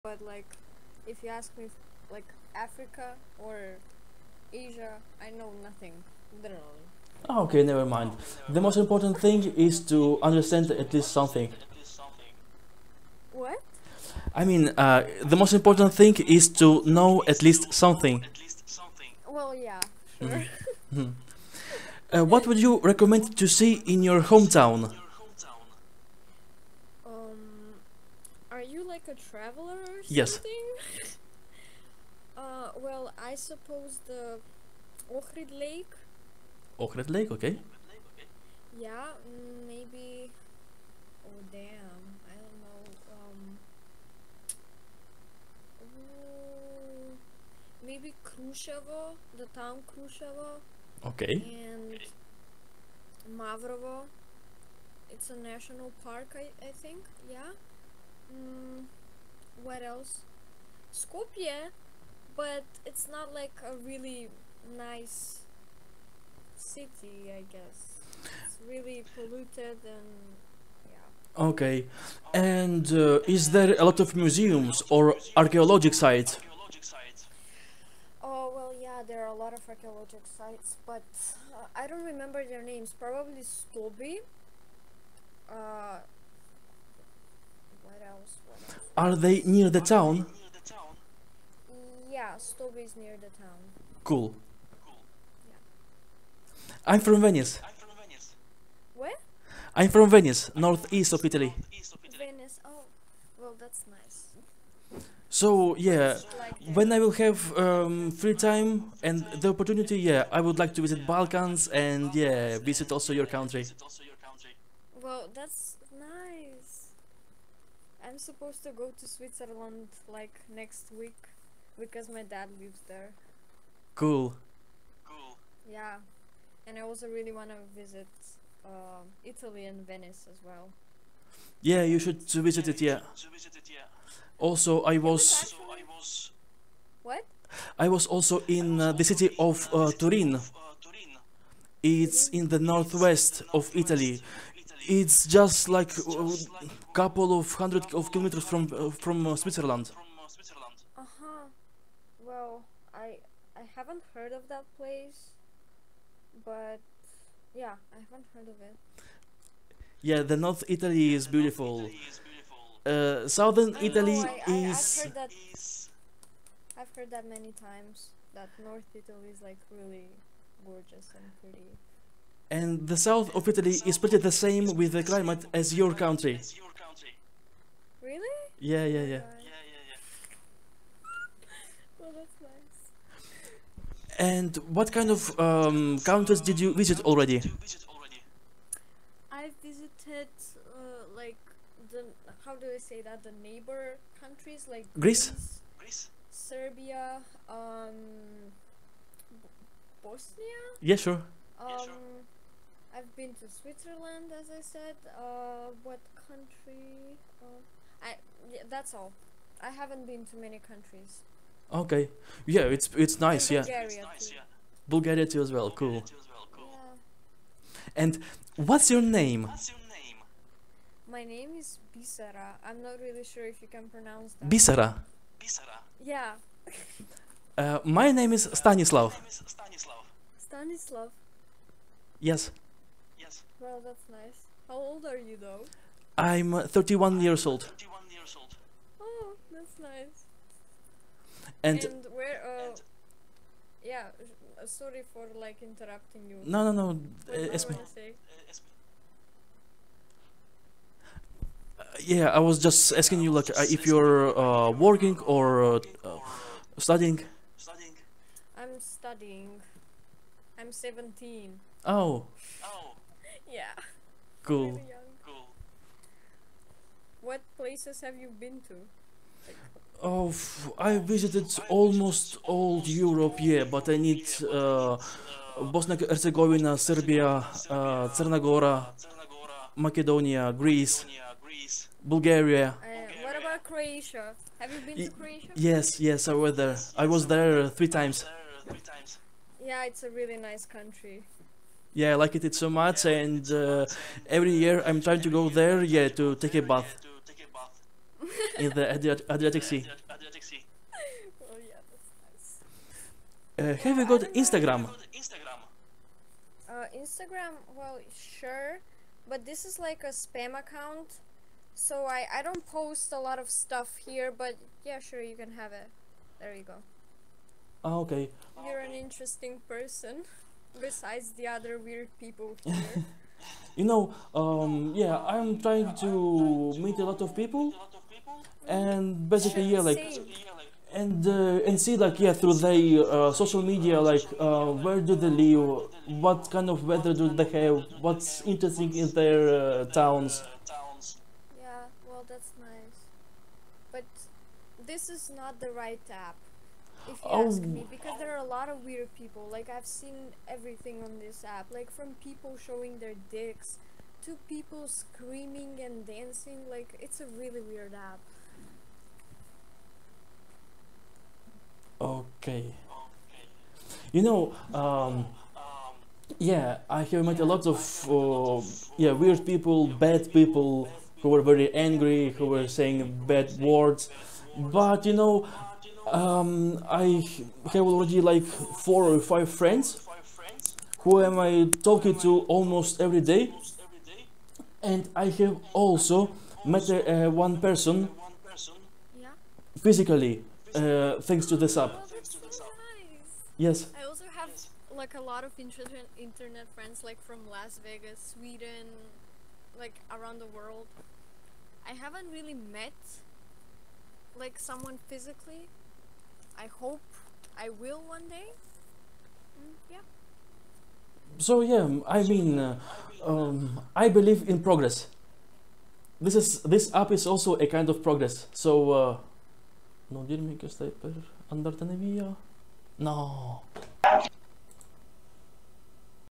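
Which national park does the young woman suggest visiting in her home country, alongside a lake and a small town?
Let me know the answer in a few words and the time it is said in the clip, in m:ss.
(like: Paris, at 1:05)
Mavrovo, at 0:53.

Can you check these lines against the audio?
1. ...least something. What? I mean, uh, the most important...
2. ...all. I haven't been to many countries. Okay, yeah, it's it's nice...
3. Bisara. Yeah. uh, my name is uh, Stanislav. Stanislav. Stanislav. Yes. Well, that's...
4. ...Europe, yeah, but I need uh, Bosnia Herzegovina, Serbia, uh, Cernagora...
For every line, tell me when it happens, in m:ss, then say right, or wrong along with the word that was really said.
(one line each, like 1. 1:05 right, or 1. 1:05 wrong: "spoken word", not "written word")
1. 0:10 right
2. 3:28 right
3. 3:45 right
4. 4:32 right.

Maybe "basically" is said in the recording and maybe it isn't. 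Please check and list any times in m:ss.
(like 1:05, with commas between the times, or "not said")
5:29.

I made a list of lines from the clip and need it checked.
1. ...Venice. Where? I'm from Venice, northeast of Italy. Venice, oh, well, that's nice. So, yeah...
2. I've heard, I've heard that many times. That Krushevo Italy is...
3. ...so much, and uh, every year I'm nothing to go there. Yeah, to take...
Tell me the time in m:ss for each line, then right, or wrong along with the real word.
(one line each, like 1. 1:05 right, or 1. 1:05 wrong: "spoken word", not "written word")
1. 1:38 right
2. 2:45 wrong: "North", not "Krushevo"
3. 4:52 wrong: "trying", not "nothing".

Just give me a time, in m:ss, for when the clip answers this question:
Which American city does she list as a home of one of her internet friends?
6:37.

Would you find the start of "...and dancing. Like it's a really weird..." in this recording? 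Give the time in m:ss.
5:55.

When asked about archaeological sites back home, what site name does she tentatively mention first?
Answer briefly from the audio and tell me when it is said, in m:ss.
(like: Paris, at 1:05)
Stobi, at 1:23.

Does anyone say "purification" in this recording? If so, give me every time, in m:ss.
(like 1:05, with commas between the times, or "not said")
not said.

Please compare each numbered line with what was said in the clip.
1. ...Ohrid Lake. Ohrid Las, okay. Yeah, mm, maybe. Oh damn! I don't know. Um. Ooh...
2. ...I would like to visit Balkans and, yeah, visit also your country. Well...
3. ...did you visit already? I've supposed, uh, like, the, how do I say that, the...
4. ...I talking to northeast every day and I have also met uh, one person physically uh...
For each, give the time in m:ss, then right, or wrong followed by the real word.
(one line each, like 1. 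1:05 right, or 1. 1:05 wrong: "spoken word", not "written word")
1. 0:35 wrong: "Lake", not "Las"
2. 1:50 right
3. 3:06 wrong: "visited", not "supposed"
4. 6:21 wrong: "almost", not "northeast".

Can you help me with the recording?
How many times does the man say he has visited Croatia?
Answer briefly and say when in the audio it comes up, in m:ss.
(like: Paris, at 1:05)
3, at 4:47.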